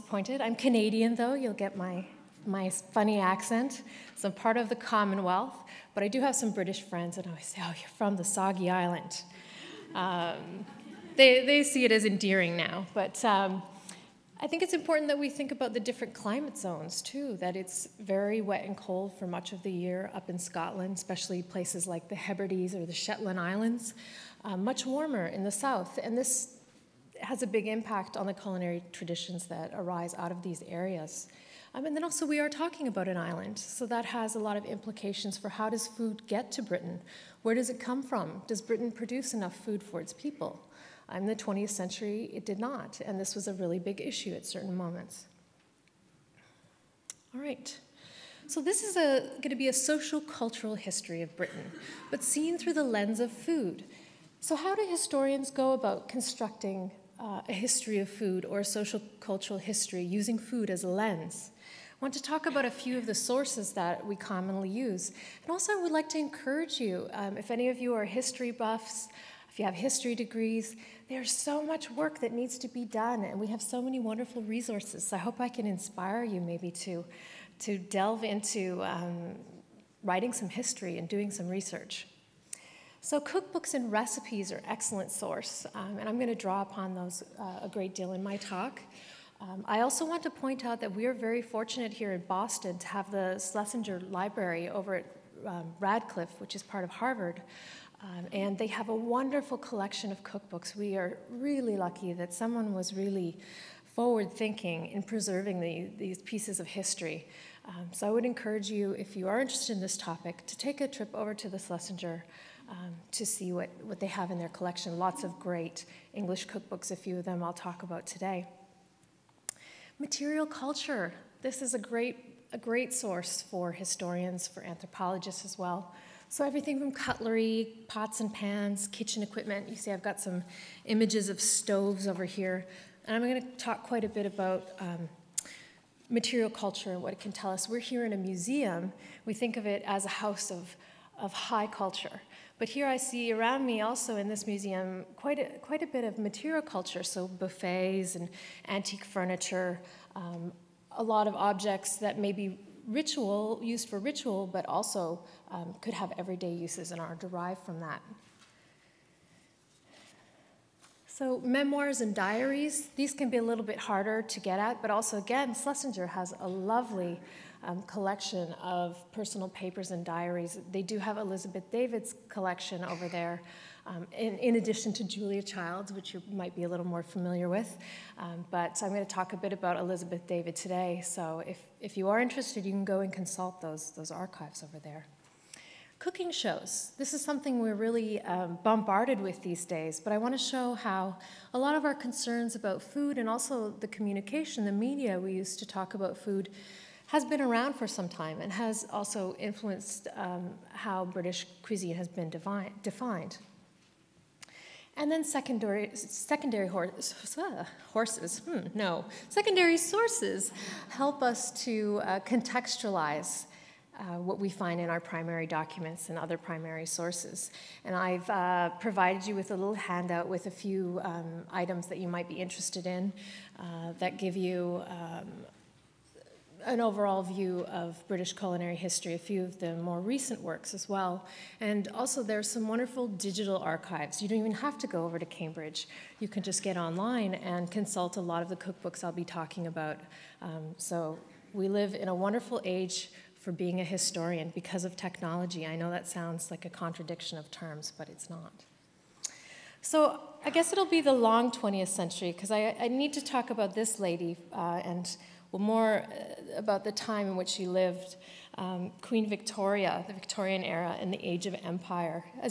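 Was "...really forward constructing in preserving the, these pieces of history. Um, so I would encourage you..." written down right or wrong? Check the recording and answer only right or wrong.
wrong.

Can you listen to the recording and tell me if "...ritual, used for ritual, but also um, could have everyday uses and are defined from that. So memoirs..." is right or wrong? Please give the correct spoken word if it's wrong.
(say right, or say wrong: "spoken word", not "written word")
wrong: "derived", not "defined".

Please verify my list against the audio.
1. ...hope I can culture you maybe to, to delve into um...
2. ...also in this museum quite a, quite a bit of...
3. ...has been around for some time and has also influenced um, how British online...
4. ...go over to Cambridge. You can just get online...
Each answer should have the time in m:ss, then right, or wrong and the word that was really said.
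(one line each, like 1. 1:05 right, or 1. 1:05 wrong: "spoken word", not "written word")
1. 1:15 wrong: "inspire", not "culture"
2. 2:23 right
3. 3:17 wrong: "cuisine", not "online"
4. 3:54 right.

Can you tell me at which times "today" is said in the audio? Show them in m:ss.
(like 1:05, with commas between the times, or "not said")
1:58, 3:00.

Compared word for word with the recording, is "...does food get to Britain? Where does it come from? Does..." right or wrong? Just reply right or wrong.
right.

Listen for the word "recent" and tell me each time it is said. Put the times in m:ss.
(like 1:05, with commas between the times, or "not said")
3:49.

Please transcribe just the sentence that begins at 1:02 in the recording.
want to talk about a few of the sources that we commonly use.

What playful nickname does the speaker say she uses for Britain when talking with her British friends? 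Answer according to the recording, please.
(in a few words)
the Soggy Island.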